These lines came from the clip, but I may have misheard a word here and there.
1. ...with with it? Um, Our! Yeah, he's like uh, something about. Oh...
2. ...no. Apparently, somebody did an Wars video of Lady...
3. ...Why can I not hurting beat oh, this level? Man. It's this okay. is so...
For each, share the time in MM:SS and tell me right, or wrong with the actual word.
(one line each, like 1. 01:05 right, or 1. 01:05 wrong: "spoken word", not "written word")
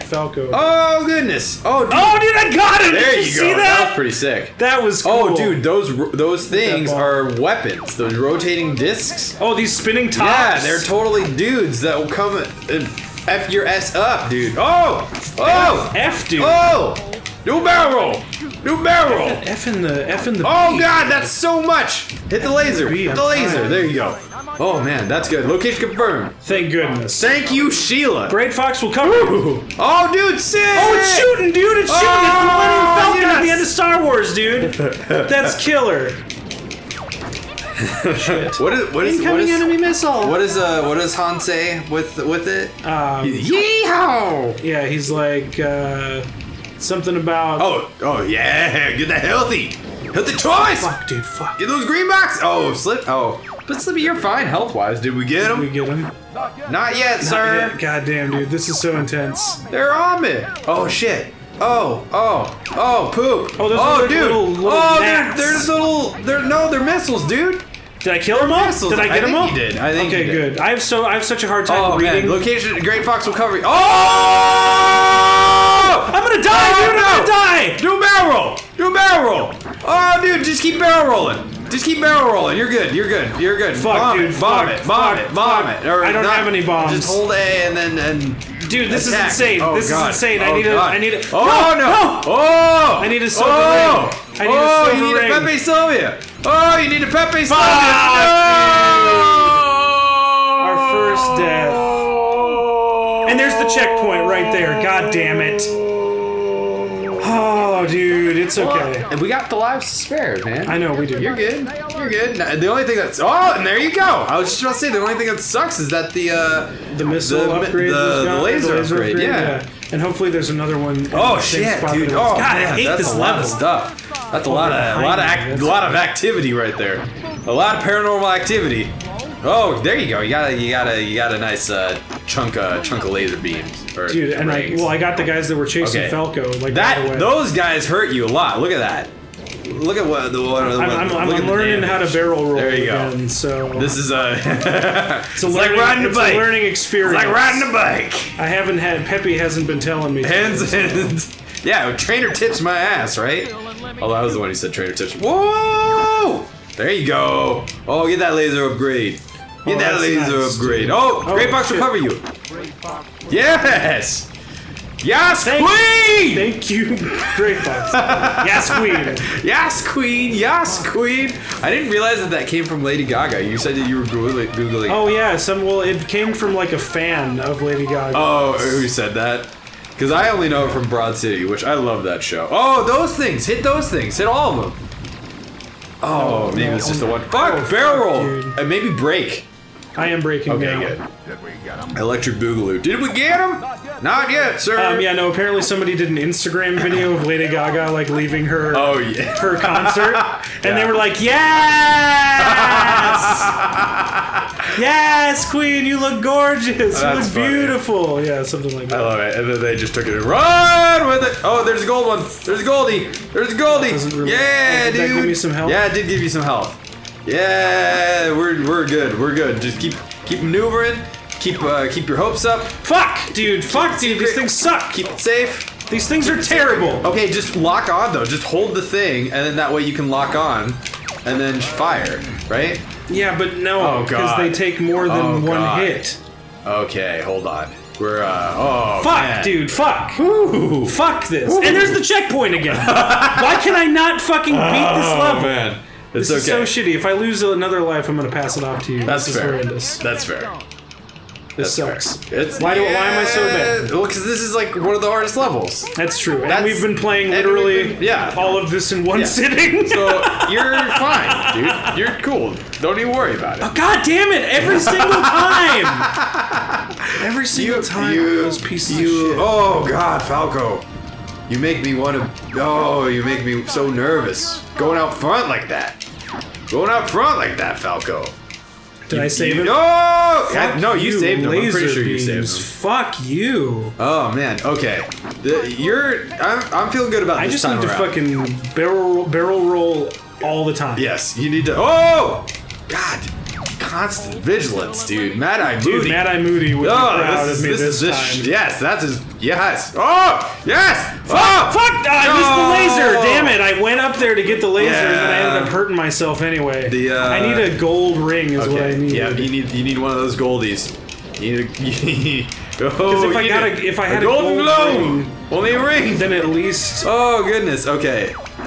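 1. 00:41 wrong: "Yeehaw", not "Our"
2. 03:15 wrong: "Instagram", not "Wars"
3. 04:02 wrong: "fucking", not "hurting".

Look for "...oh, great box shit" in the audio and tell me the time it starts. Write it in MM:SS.
02:41.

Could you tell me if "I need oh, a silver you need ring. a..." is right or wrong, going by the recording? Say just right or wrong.
right.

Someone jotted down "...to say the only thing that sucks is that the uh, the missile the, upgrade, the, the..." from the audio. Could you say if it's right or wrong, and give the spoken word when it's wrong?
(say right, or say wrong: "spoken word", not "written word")
right.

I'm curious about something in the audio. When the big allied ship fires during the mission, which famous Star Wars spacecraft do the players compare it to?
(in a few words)
Millennium Falcon.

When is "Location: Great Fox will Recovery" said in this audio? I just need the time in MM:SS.
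01:12.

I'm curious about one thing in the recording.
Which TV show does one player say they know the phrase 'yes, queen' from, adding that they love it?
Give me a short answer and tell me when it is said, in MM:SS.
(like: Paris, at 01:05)
Broad City, at 03:00.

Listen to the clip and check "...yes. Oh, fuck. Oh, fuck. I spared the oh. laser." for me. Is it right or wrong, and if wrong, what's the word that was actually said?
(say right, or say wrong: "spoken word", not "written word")
wrong: "missed", not "spared".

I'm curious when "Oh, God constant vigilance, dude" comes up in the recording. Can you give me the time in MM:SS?
04:51.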